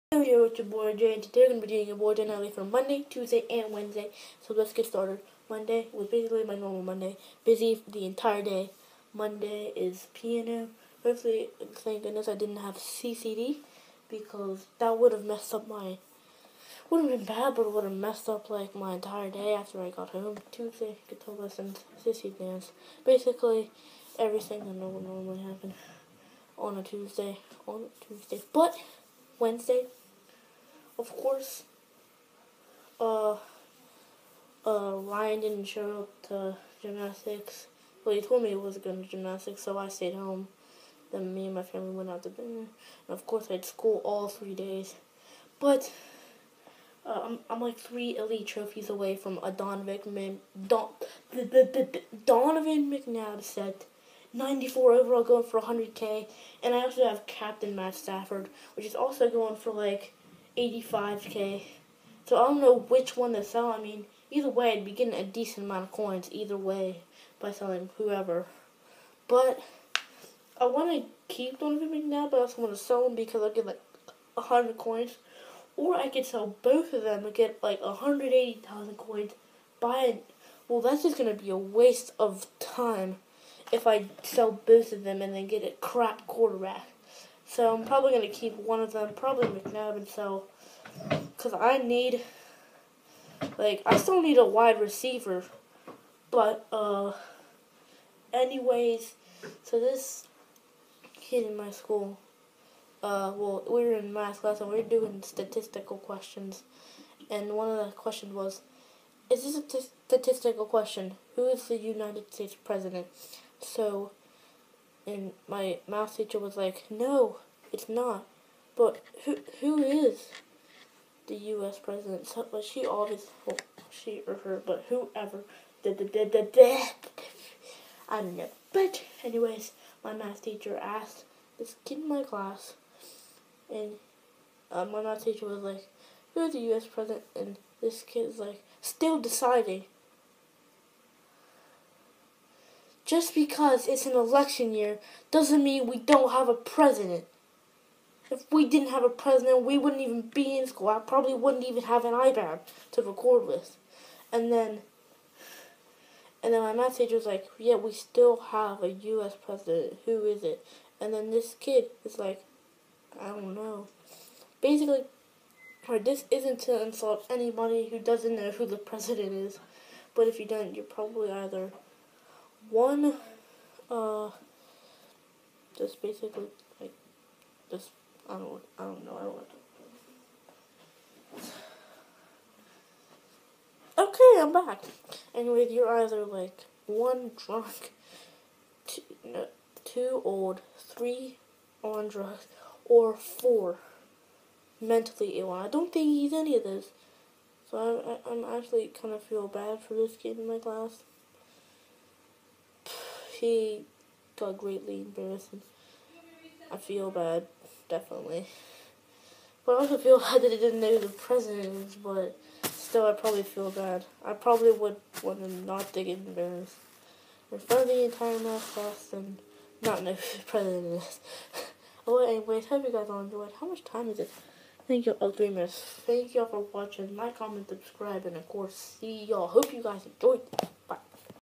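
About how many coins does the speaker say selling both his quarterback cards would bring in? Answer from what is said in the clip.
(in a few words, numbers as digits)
180,000.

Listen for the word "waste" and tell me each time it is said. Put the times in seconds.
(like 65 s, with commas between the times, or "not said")
81 s.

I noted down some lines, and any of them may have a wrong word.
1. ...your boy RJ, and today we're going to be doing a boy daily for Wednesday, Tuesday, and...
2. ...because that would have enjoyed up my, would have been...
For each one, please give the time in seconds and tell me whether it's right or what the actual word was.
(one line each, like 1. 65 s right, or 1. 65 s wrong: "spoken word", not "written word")
1. 0 s wrong: "Monday", not "Wednesday"
2. 14 s wrong: "messed", not "enjoyed".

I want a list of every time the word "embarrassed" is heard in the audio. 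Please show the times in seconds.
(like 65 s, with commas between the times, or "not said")
205 s, 216 s.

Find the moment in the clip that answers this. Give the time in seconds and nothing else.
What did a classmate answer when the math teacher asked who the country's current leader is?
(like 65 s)
138 s.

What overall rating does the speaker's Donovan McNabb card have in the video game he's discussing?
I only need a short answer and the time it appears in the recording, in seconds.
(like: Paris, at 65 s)
94, at 54 s.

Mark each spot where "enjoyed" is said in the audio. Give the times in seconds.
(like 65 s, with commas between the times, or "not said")
223 s, 230 s.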